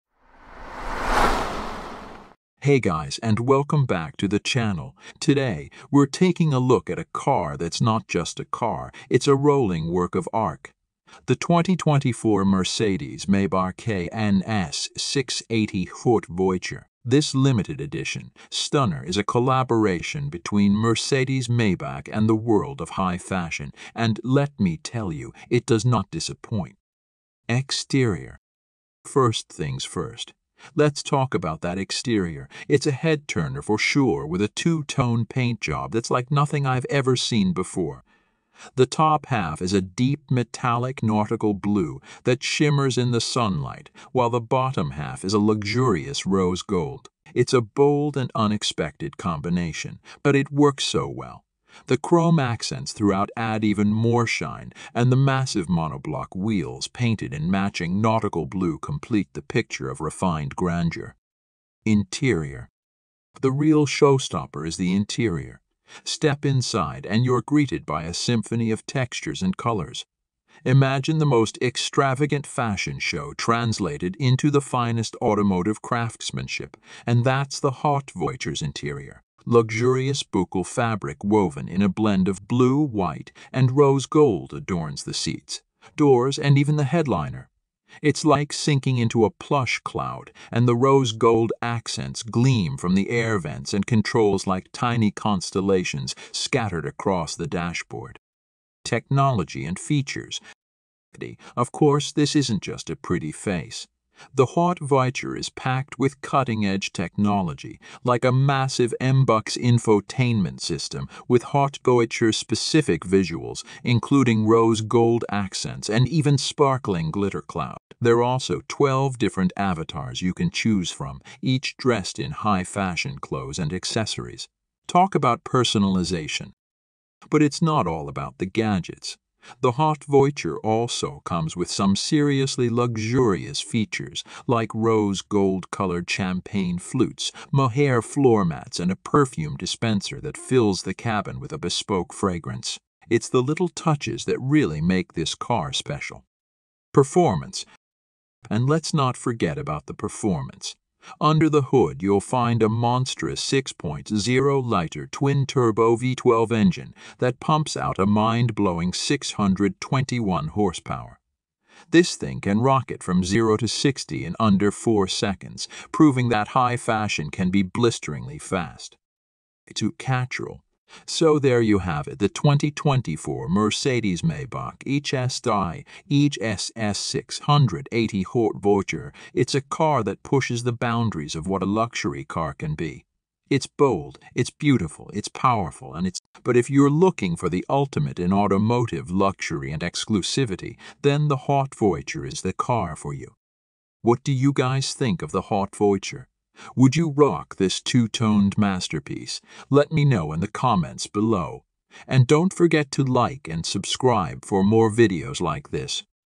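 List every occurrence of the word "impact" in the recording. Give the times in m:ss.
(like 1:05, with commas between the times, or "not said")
not said.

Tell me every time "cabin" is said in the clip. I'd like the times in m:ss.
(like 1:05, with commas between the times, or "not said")
2:20.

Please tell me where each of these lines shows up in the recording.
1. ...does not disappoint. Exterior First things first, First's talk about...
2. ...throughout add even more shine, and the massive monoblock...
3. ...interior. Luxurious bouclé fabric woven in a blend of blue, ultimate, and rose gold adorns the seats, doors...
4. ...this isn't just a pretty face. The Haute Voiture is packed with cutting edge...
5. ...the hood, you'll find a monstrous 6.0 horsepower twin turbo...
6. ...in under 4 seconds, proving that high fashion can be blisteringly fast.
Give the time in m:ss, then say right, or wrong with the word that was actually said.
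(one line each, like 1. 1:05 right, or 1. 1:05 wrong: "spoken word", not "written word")
1. 0:25 wrong: "Let", not "First"
2. 0:52 right
3. 1:18 wrong: "white", not "ultimate"
4. 1:42 right
5. 2:31 wrong: "liter", not "horsepower"
6. 2:44 right.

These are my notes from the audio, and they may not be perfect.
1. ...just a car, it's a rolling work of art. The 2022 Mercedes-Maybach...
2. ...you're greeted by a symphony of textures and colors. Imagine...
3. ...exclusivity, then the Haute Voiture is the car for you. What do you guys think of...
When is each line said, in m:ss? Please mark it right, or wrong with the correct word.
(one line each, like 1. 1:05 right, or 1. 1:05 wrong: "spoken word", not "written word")
1. 0:08 wrong: "2024", not "2022"
2. 1:07 right
3. 3:09 right.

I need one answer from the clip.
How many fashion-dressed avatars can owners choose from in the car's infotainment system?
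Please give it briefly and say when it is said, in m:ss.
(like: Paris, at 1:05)
12, at 1:58.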